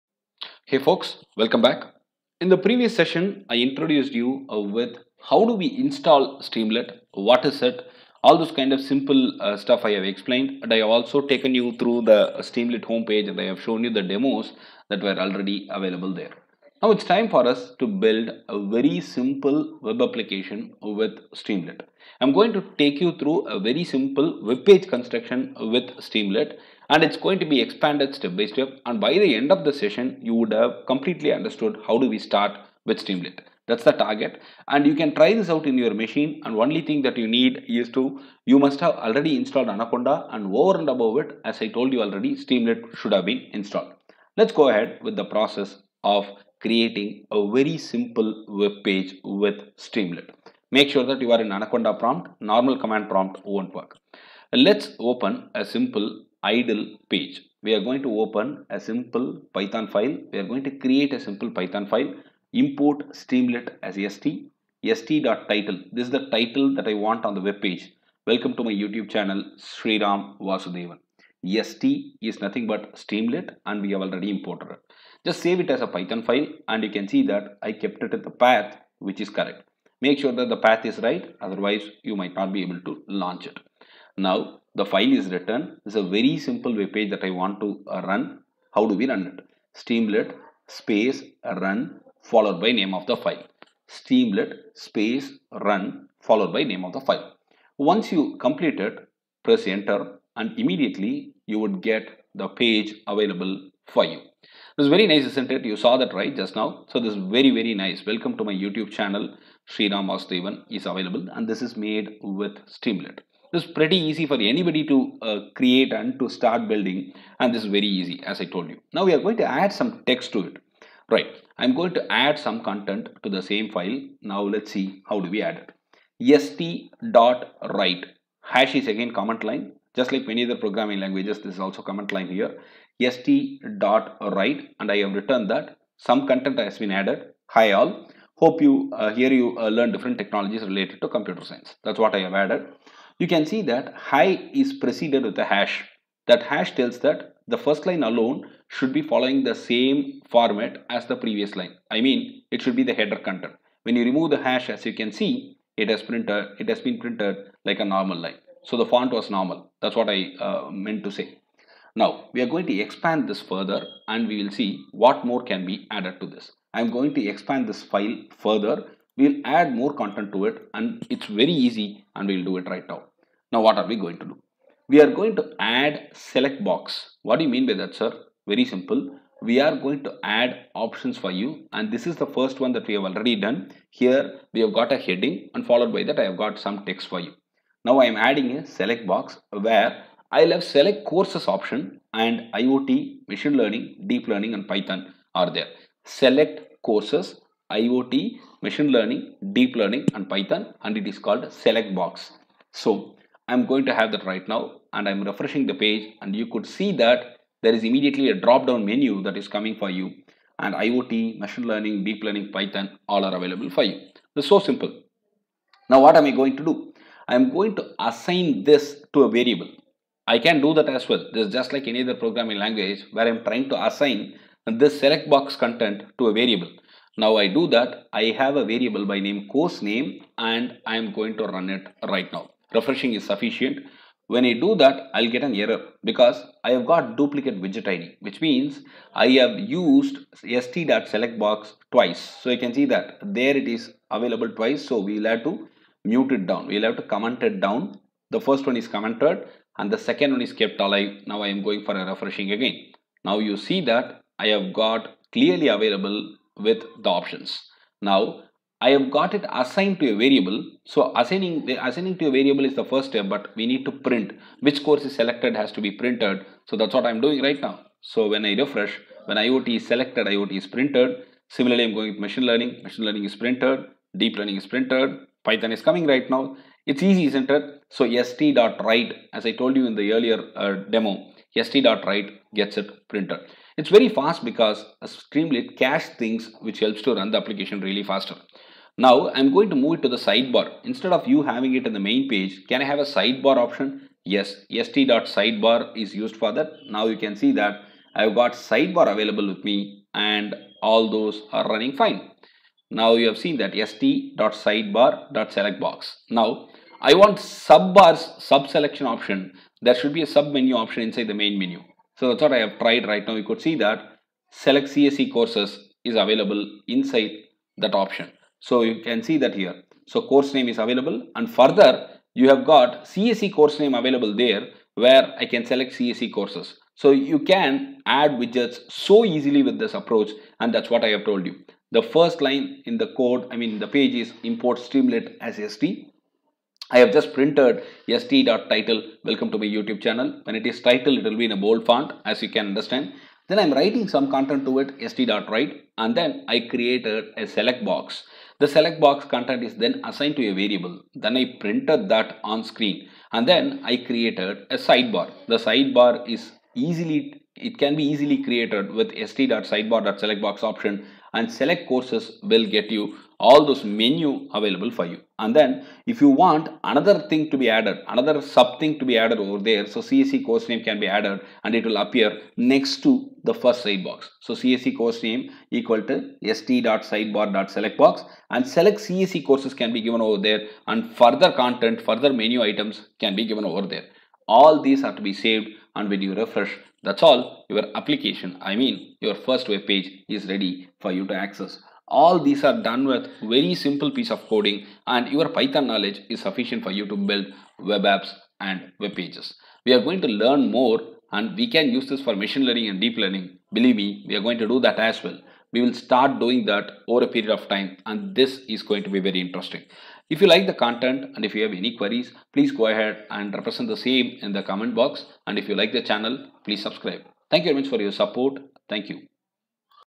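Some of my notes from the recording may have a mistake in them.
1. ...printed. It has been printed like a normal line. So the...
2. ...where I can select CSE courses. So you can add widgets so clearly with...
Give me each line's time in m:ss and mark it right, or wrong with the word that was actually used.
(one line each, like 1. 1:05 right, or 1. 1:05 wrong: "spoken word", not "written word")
1. 2:36 right
2. 5:24 wrong: "easily", not "clearly".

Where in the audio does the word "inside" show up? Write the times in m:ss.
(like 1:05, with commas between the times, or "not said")
5:11, 5:16.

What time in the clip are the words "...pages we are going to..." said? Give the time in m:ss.
6:39.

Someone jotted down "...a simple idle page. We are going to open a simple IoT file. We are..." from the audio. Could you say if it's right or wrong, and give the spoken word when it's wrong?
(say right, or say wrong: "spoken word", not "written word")
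wrong: "Python", not "IoT".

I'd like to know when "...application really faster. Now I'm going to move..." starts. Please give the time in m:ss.
4:47.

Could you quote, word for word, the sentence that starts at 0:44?
Let's go ahead with the process of creating a very simple web page with Streamlit.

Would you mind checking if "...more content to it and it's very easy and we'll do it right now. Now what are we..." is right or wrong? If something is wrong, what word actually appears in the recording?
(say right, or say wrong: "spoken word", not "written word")
right.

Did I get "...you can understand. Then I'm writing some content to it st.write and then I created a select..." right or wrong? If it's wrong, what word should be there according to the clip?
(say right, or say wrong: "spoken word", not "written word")
right.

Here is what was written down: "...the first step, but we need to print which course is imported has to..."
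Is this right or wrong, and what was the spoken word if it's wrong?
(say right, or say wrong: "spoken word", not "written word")
wrong: "selected", not "imported".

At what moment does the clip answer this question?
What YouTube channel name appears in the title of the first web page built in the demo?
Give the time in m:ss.
1:09.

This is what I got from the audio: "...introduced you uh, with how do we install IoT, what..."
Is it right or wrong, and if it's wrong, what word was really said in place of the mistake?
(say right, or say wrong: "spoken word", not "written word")
wrong: "Streamlit", not "IoT".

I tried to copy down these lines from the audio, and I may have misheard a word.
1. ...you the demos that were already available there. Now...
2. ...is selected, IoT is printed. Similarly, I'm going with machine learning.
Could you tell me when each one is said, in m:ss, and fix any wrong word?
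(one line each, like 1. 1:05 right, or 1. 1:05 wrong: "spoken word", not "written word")
1. 0:13 right
2. 4:29 right.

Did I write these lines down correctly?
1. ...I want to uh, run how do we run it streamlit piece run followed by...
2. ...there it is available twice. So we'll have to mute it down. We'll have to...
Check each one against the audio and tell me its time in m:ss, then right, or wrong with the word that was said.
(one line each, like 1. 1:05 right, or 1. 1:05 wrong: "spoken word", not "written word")
1. 1:27 wrong: "space", not "piece"
2. 4:03 right.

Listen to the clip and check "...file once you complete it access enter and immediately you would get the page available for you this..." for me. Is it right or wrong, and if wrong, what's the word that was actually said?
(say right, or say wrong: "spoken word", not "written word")
wrong: "press", not "access".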